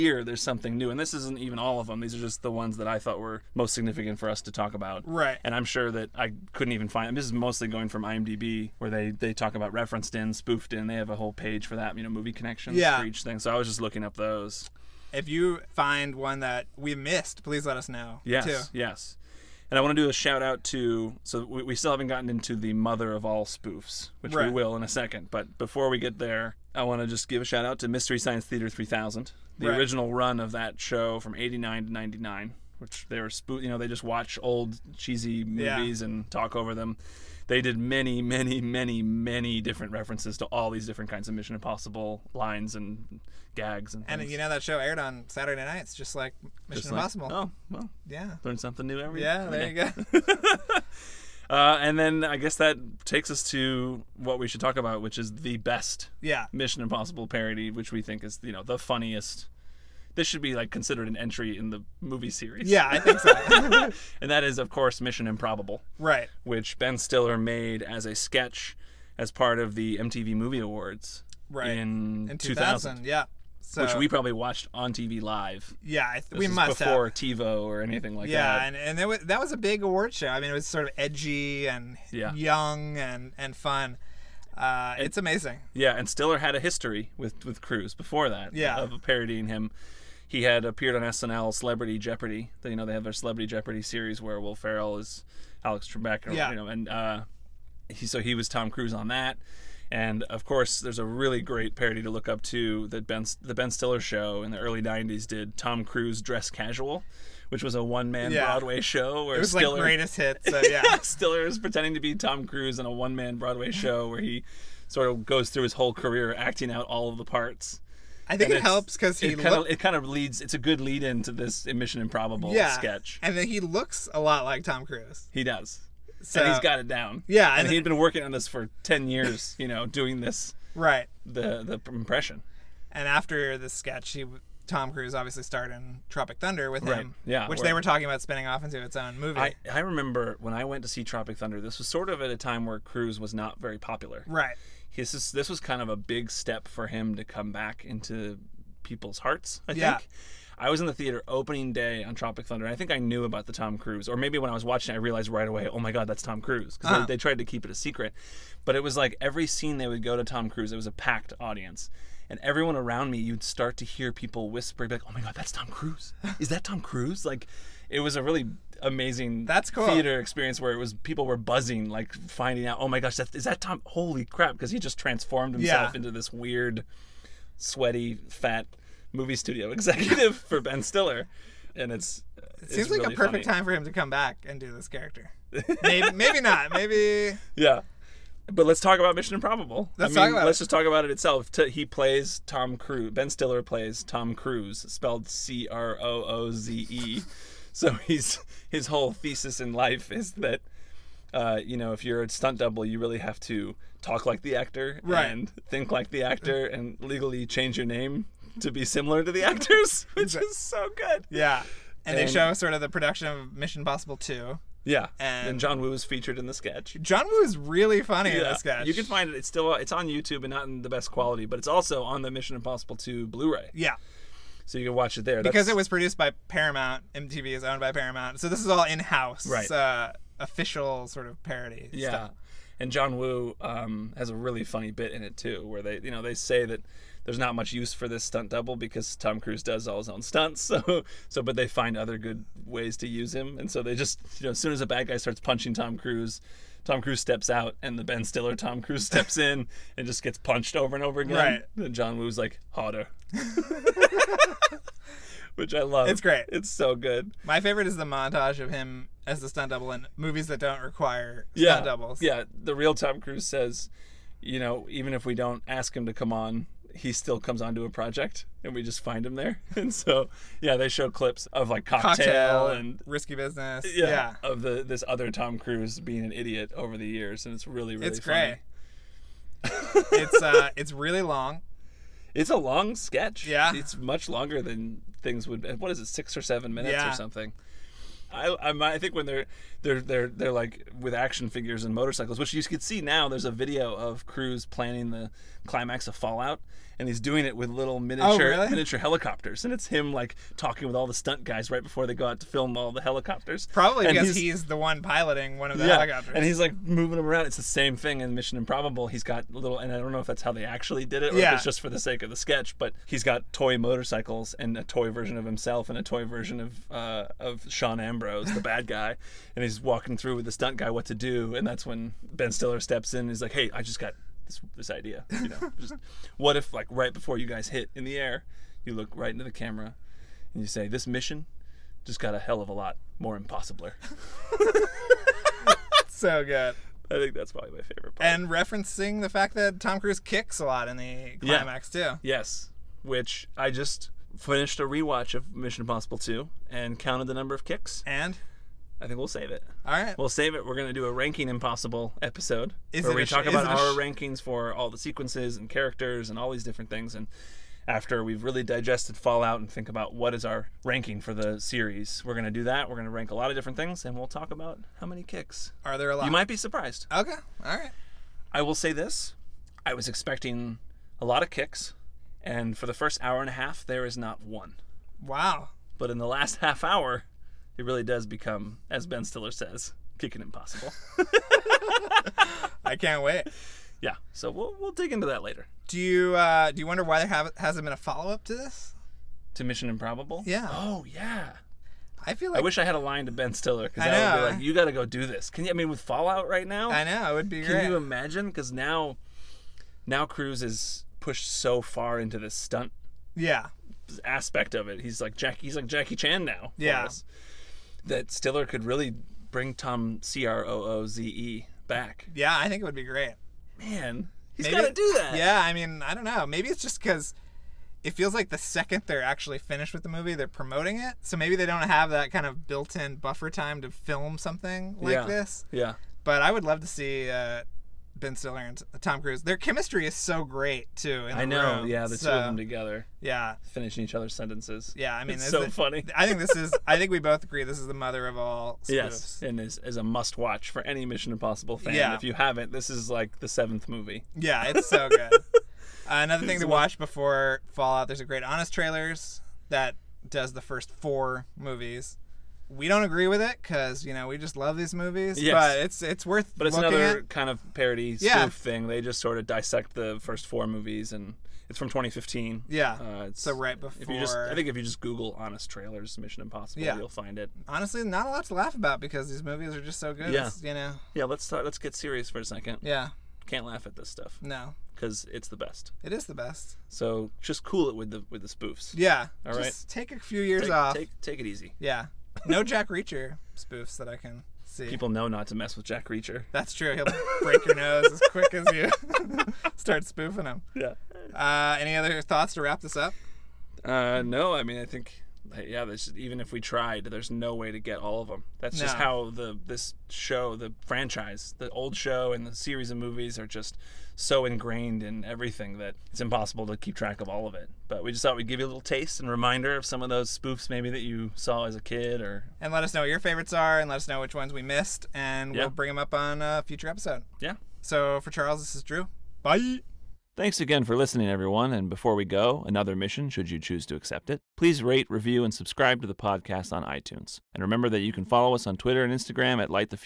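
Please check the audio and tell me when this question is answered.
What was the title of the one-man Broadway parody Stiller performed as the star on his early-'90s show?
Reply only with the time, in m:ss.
1:45.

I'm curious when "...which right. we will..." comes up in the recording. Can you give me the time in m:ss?
0:24.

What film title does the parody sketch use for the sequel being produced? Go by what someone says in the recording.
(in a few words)
Mission Possible 2.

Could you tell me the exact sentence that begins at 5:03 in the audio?
Probably and because he's, he's, the one piloting one of the yeah, helicopters, and he's like moving them around.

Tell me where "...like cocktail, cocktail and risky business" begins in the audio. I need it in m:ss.
4:31.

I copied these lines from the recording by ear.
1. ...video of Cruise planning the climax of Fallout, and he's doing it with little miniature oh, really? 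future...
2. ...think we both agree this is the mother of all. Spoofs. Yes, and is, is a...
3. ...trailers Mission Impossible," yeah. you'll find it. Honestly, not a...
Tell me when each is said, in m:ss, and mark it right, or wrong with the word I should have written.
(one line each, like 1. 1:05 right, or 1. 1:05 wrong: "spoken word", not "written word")
1. 4:53 wrong: "miniature", not "future"
2. 7:16 right
3. 7:45 right.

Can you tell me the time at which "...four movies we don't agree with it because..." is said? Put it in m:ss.
7:30.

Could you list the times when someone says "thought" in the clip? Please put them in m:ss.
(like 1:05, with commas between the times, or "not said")
0:02, 8:12, 8:28.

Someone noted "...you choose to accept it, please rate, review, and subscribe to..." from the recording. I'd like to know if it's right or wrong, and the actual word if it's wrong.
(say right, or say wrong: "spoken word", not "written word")
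right.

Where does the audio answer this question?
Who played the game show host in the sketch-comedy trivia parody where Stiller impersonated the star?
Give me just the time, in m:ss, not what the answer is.
1:34.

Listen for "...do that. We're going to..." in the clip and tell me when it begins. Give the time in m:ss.
6:02.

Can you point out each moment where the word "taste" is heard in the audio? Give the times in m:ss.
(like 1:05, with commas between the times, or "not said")
8:28.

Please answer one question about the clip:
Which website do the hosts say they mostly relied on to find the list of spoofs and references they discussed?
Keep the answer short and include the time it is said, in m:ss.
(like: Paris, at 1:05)
IMDb, at 0:08.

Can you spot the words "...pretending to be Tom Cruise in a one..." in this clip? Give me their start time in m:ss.
1:51.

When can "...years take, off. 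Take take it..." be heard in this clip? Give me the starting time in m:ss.
8:00.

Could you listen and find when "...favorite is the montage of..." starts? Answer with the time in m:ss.
4:17.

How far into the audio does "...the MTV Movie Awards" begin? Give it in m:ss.
1:09.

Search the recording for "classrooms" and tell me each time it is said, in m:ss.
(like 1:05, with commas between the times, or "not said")
not said.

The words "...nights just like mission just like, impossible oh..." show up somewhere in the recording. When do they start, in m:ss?
0:45.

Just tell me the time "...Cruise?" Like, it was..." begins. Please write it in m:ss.
2:46.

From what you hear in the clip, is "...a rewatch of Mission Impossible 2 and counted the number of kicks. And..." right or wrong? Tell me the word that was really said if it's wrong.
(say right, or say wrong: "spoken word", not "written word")
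right.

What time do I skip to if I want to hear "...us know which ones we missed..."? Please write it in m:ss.
8:33.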